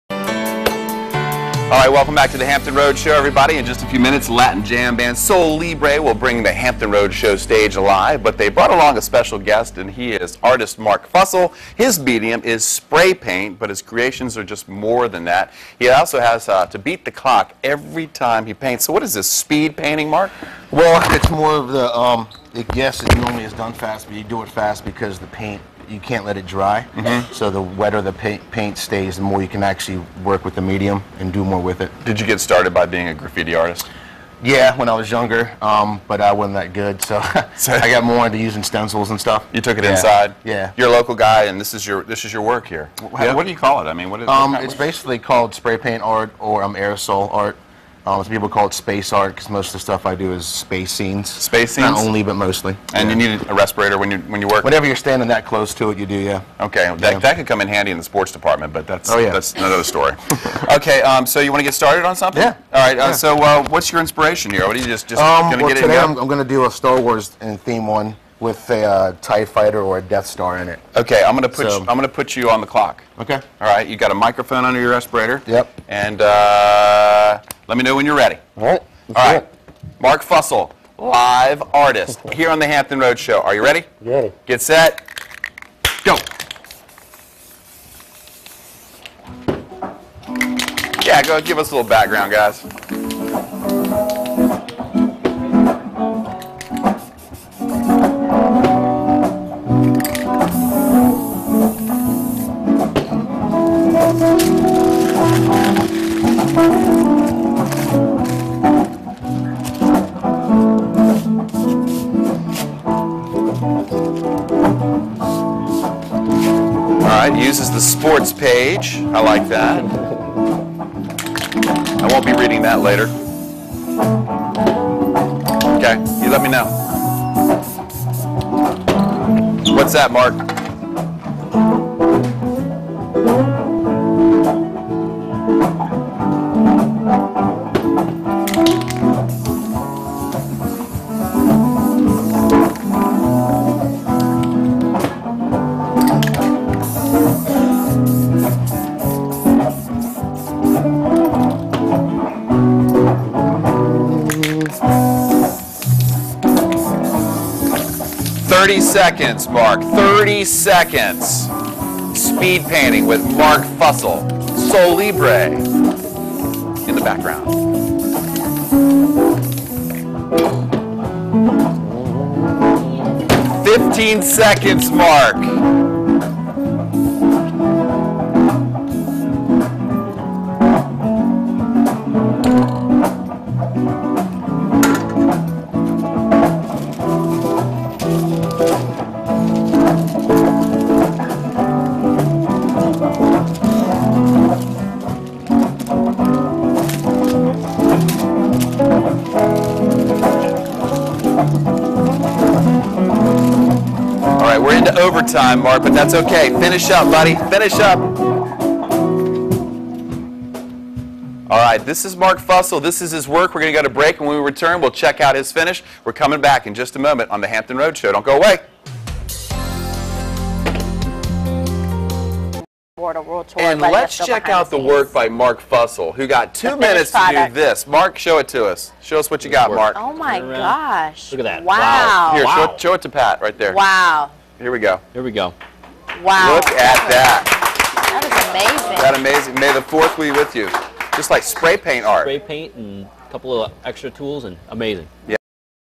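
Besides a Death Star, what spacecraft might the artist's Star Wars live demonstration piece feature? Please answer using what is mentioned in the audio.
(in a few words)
Tie Fighter.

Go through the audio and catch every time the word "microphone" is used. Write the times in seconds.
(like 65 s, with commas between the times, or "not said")
74 s.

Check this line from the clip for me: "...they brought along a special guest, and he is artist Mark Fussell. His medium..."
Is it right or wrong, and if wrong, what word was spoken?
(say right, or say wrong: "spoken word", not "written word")
right.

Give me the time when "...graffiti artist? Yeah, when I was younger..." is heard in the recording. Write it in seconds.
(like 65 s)
33 s.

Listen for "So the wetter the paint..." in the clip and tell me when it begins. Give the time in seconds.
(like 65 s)
27 s.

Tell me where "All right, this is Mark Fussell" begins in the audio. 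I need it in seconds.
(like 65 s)
211 s.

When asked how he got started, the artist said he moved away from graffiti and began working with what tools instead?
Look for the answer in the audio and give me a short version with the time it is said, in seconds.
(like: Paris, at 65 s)
Stencils, at 38 s.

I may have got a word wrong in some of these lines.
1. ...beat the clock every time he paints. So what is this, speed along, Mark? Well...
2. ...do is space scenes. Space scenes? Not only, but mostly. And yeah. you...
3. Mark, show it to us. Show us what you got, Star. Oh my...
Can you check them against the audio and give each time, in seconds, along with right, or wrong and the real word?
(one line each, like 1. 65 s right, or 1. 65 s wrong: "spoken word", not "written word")
1. 16 s wrong: "painting", not "along"
2. 50 s right
3. 227 s wrong: "Mark", not "Star".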